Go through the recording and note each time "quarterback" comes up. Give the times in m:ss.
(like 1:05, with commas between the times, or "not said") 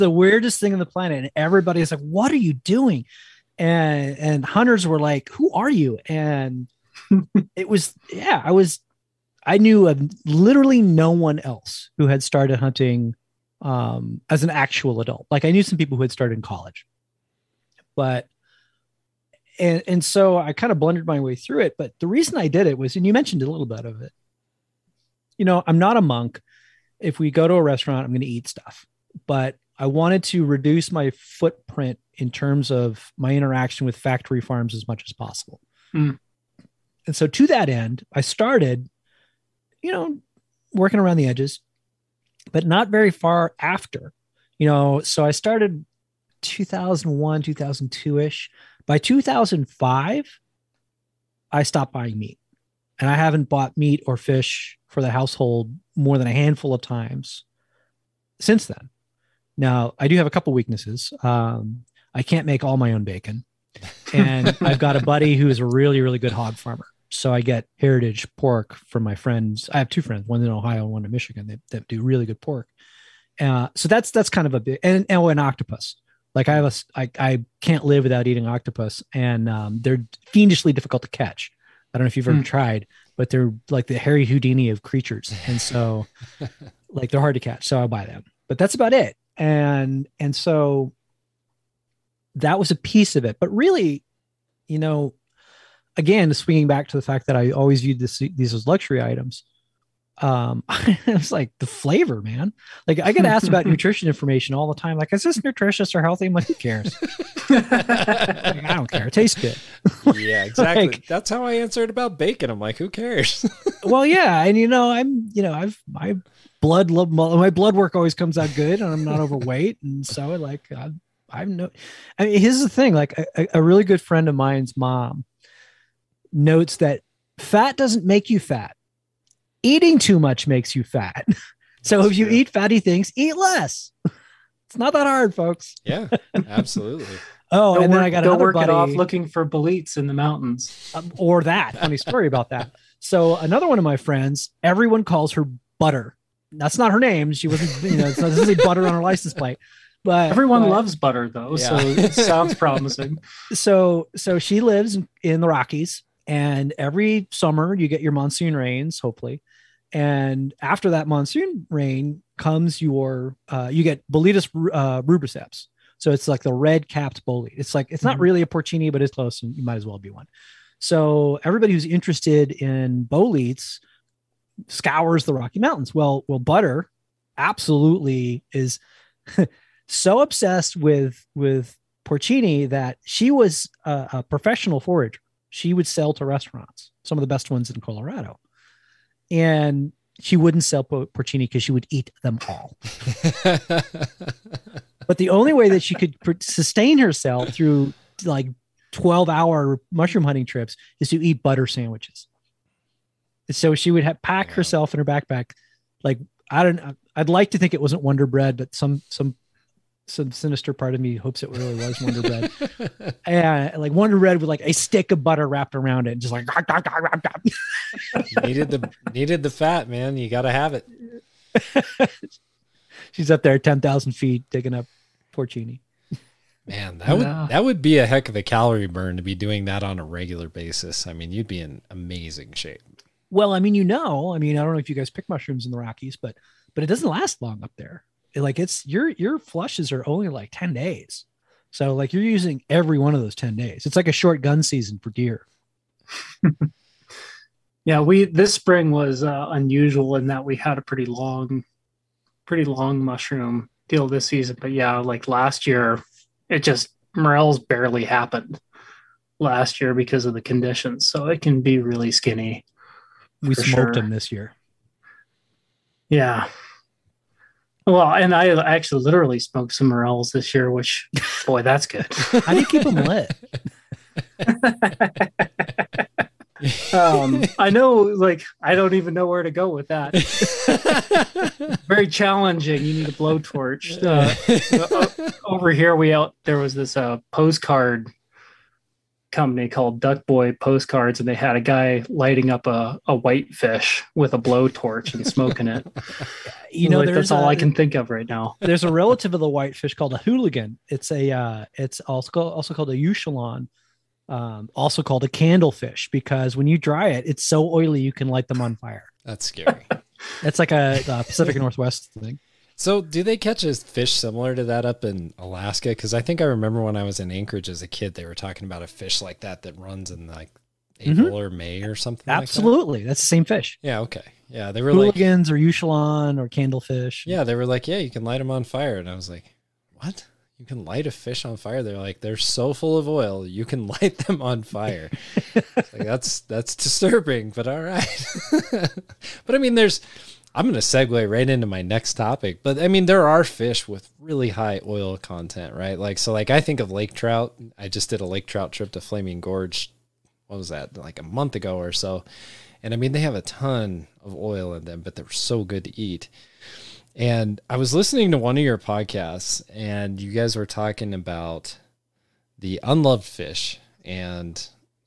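not said.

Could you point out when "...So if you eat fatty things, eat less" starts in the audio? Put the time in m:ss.
2:11.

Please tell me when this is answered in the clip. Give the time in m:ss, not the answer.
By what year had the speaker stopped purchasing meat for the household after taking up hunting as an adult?
0:48.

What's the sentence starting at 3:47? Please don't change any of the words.
would that would be a heck of a calorie burn to be doing that on a regular basis.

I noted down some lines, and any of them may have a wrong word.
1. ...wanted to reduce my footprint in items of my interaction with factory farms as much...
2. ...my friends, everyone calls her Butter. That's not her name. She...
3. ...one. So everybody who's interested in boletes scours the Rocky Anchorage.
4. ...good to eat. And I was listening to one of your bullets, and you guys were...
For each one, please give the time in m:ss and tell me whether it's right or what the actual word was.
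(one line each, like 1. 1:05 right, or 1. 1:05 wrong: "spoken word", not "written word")
1. 0:29 wrong: "terms", not "items"
2. 2:23 right
3. 2:50 wrong: "Mountains", not "Anchorage"
4. 5:55 wrong: "podcasts", not "bullets".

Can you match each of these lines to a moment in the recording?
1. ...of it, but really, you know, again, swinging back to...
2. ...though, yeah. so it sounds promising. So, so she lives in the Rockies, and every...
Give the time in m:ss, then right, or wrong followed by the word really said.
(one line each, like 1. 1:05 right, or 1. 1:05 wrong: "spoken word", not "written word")
1. 1:33 right
2. 2:31 right.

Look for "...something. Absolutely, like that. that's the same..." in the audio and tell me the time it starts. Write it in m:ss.
5:21.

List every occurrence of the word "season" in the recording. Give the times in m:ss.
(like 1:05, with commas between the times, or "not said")
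4:04, 4:14.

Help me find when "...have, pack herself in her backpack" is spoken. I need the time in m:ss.
3:24.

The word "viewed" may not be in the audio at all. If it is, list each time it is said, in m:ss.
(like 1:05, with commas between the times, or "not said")
1:37.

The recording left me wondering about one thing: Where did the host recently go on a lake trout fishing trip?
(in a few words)
Flaming Gorge.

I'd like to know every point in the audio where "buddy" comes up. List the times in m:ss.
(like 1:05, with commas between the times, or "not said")
1:05, 2:18.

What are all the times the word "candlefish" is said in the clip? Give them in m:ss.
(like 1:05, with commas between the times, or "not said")
5:05, 5:26.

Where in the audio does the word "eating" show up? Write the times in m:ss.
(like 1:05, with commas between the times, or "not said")
1:18, 2:09.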